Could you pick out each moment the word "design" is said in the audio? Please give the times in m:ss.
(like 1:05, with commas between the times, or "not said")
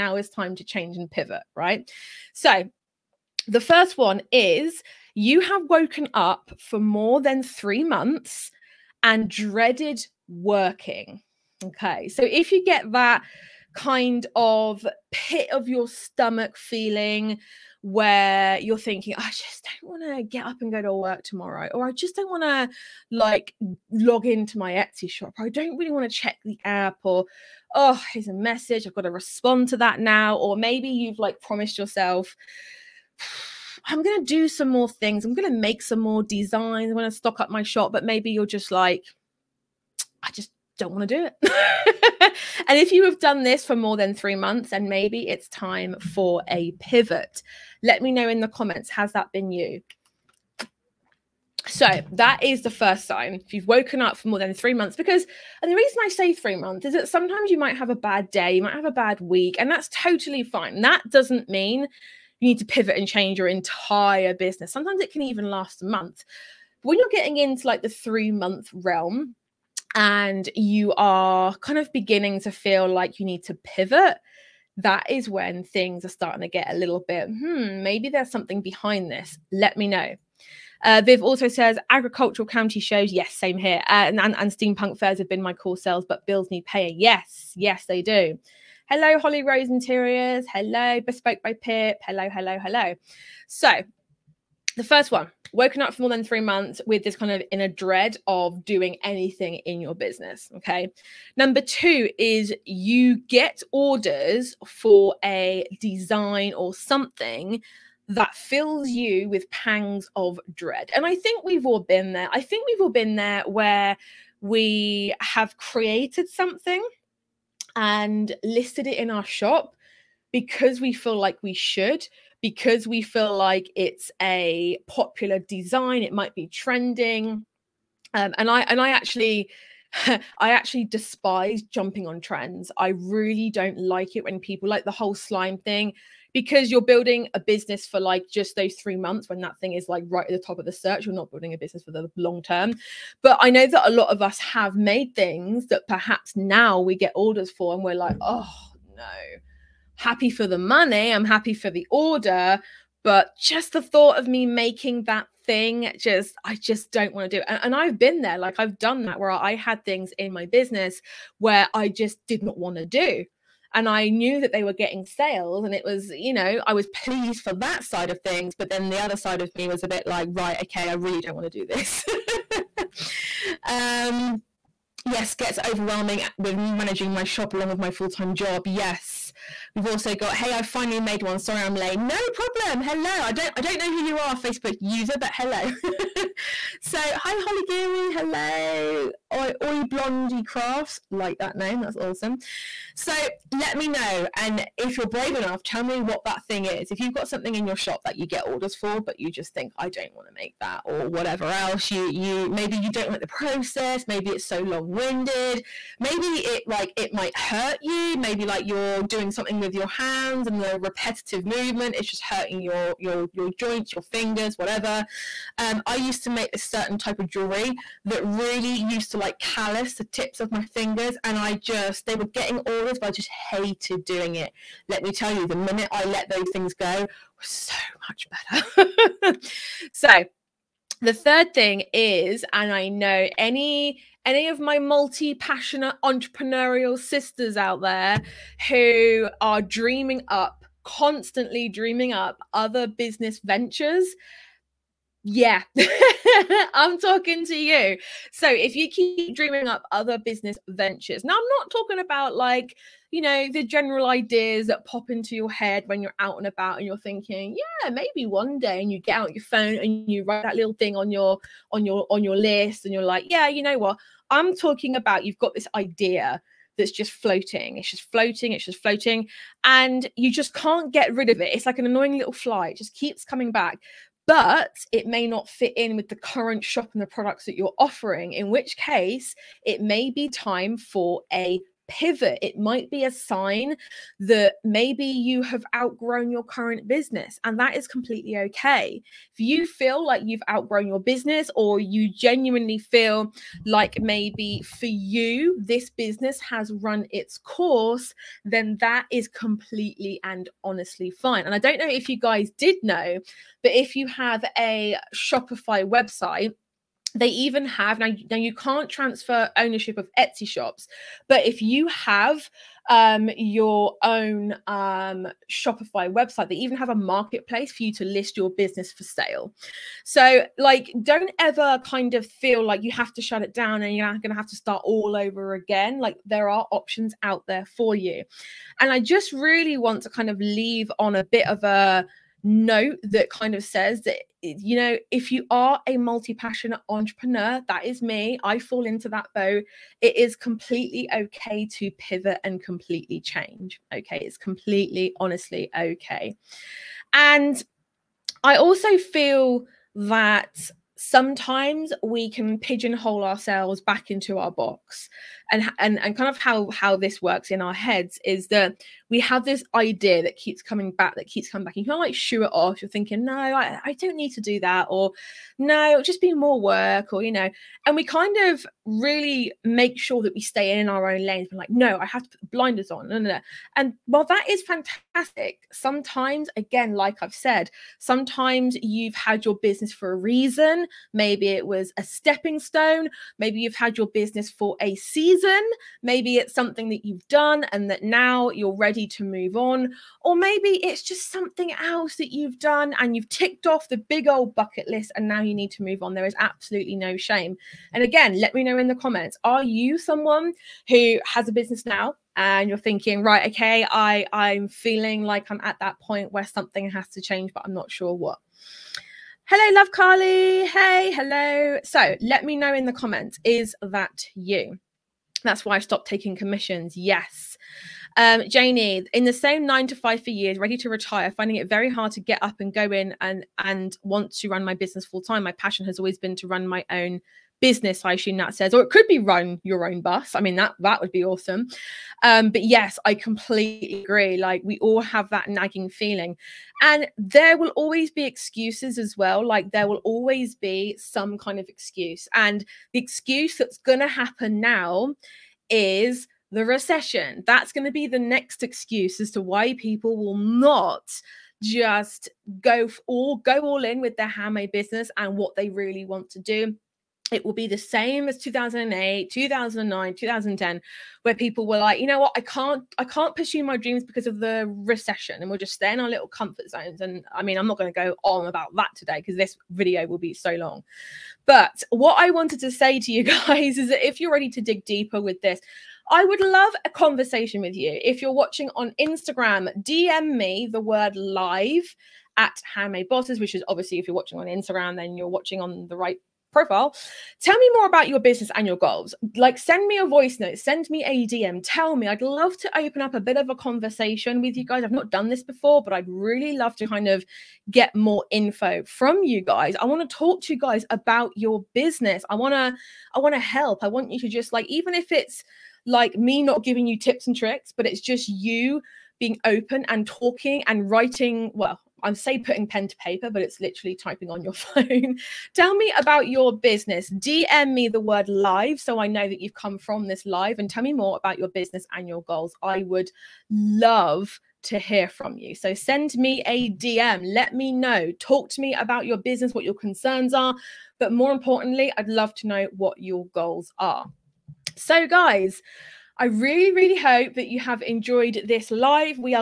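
0:36, 1:45, 2:05.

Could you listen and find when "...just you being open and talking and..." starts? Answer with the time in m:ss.
8:27.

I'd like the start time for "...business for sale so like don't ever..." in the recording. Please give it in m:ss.
5:18.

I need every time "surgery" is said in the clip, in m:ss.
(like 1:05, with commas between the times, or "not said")
not said.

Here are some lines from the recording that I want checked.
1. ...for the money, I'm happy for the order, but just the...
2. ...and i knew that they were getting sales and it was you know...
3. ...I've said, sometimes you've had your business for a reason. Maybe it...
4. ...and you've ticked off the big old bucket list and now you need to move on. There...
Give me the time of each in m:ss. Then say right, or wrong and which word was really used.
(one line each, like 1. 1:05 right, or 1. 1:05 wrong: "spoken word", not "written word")
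1. 2:30 right
2. 2:43 right
3. 6:17 right
4. 6:32 right.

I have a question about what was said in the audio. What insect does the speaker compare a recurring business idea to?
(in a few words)
Fly.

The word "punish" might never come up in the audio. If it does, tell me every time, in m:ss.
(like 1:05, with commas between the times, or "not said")
not said.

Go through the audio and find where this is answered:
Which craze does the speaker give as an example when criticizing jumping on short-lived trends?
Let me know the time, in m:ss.
2:15.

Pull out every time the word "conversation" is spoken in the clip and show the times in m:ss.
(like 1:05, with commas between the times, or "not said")
7:56, 8:13.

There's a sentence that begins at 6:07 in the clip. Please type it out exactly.
And we kind of really make sure that we stay in our own lanes.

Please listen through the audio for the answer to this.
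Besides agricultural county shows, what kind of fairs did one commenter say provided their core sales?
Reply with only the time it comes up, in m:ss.
1:24.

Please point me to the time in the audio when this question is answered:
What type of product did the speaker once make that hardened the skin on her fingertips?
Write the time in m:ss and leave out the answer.
3:37.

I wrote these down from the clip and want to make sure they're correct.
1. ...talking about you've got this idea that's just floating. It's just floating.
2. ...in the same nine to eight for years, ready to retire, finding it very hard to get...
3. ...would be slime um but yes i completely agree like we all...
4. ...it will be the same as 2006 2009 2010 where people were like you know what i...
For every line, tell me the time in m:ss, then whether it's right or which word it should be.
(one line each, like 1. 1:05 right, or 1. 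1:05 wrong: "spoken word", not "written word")
1. 4:24 right
2. 6:59 wrong: "five", not "eight"
3. 7:10 wrong: "awesome", not "slime"
4. 7:37 wrong: "2008", not "2006".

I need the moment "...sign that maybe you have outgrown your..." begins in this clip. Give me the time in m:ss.
4:43.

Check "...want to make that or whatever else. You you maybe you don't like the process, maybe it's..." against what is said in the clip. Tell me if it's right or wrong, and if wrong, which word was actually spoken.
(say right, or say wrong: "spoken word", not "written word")
right.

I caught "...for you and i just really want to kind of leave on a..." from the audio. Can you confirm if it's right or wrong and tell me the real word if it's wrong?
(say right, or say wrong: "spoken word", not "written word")
right.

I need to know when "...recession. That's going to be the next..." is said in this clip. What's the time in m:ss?
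7:26.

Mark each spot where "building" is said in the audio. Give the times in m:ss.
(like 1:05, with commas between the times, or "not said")
2:16, 2:21.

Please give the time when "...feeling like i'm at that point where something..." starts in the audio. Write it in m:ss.
6:44.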